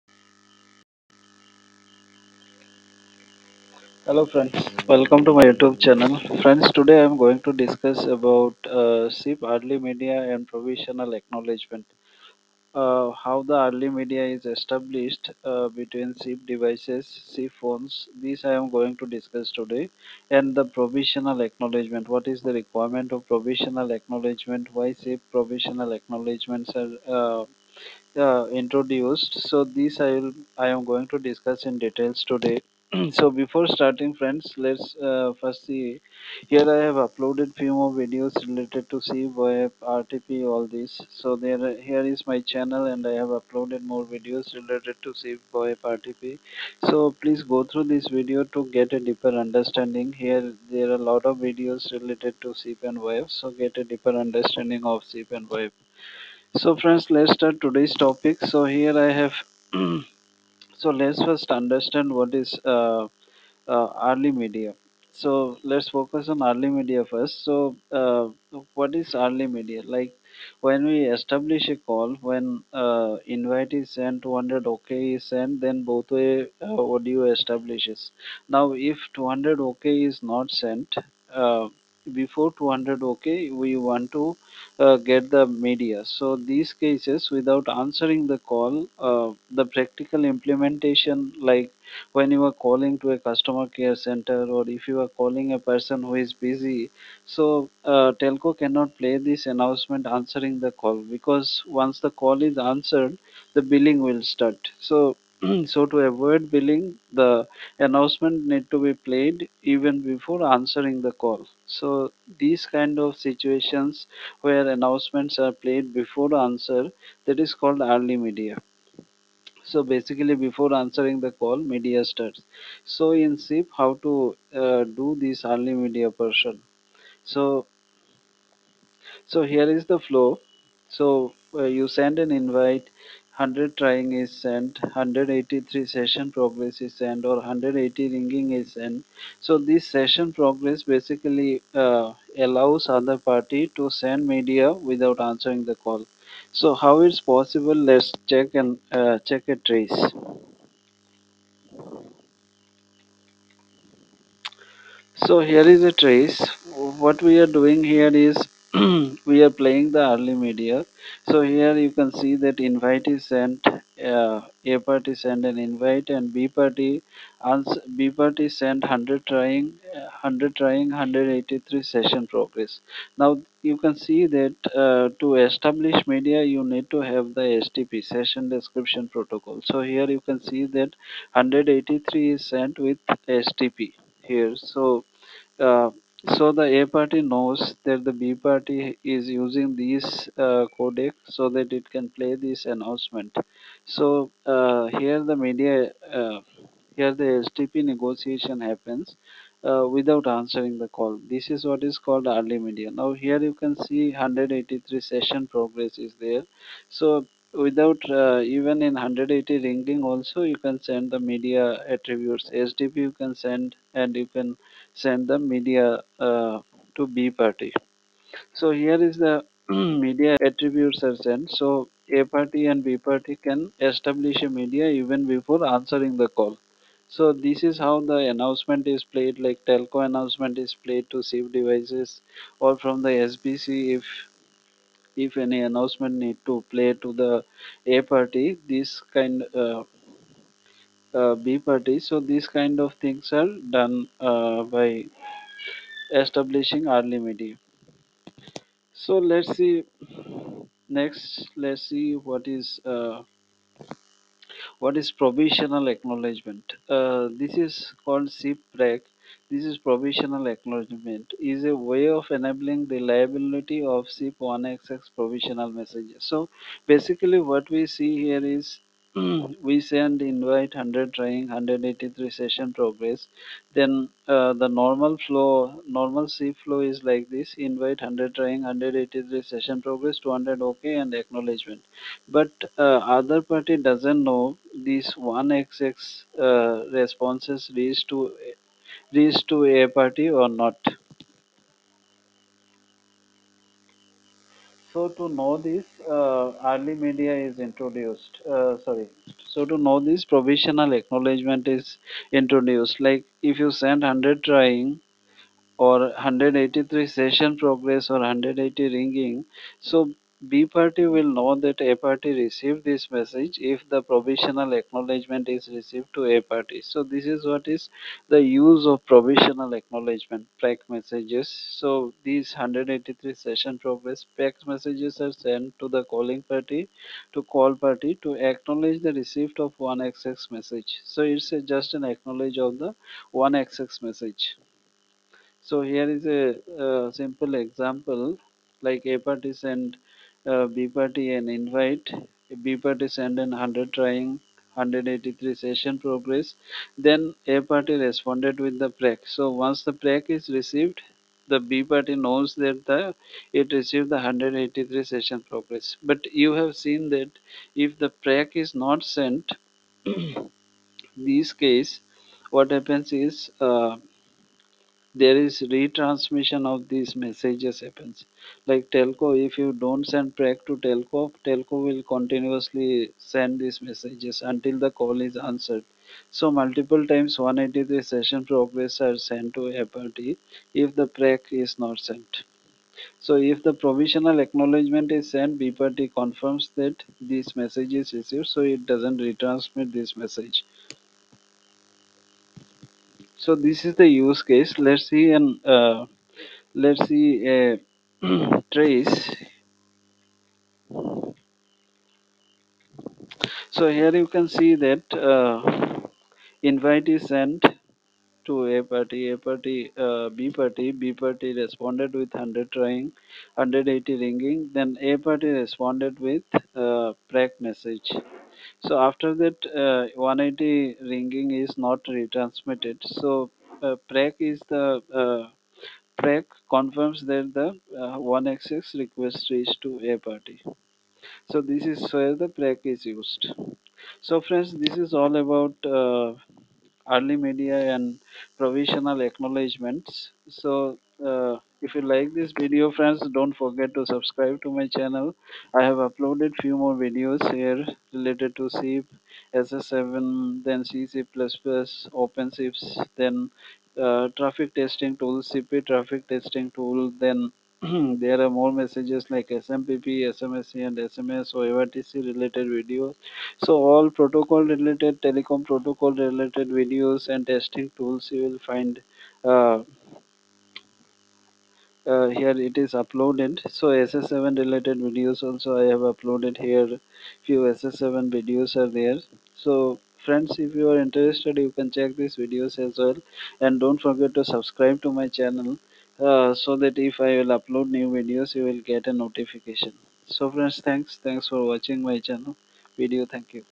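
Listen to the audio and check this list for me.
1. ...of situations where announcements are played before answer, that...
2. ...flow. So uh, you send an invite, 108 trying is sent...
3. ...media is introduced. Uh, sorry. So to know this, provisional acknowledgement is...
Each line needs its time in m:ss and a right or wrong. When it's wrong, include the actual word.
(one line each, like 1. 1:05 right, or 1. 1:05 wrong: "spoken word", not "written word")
1. 1:52 right
2. 2:09 wrong: "100", not "108"
3. 4:56 right.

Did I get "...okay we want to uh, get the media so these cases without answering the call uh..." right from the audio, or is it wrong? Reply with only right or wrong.
right.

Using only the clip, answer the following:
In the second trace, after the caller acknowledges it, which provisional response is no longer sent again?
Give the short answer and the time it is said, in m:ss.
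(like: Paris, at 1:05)
180 ringing, at 7:00.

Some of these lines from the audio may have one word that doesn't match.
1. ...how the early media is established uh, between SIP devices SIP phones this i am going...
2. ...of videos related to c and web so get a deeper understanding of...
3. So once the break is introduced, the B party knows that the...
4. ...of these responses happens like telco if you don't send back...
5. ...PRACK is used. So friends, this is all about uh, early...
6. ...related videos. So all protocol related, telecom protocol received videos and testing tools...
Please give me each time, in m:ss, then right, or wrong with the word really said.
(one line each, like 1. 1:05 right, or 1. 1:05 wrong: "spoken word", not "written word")
1. 0:13 right
2. 0:51 right
3. 5:49 wrong: "received", not "introduced"
4. 6:06 wrong: "messages", not "responses"
5. 7:12 right
6. 7:42 wrong: "related", not "received".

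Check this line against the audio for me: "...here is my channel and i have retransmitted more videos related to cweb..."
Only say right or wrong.
wrong.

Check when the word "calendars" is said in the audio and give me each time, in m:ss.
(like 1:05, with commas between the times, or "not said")
not said.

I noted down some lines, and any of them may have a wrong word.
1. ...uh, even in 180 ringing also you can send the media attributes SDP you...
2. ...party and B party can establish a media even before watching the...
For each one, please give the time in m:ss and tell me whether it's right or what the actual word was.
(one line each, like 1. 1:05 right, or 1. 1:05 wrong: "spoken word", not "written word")
1. 3:28 right
2. 3:42 wrong: "answering", not "watching".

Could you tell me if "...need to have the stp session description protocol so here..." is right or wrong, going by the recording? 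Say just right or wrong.
right.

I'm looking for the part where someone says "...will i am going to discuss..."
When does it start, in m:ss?
0:30.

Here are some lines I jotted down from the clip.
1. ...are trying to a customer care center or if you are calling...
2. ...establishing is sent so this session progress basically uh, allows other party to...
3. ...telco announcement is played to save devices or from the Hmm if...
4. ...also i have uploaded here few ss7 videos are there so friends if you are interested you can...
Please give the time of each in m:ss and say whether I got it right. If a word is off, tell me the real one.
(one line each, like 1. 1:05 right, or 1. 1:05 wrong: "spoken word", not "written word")
1. 1:32 wrong: "calling", not "trying"
2. 2:18 wrong: "ringing", not "establishing"
3. 3:49 wrong: "SBC", not "Hmm"
4. 7:55 right.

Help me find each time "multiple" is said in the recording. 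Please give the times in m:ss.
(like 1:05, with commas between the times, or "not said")
6:16.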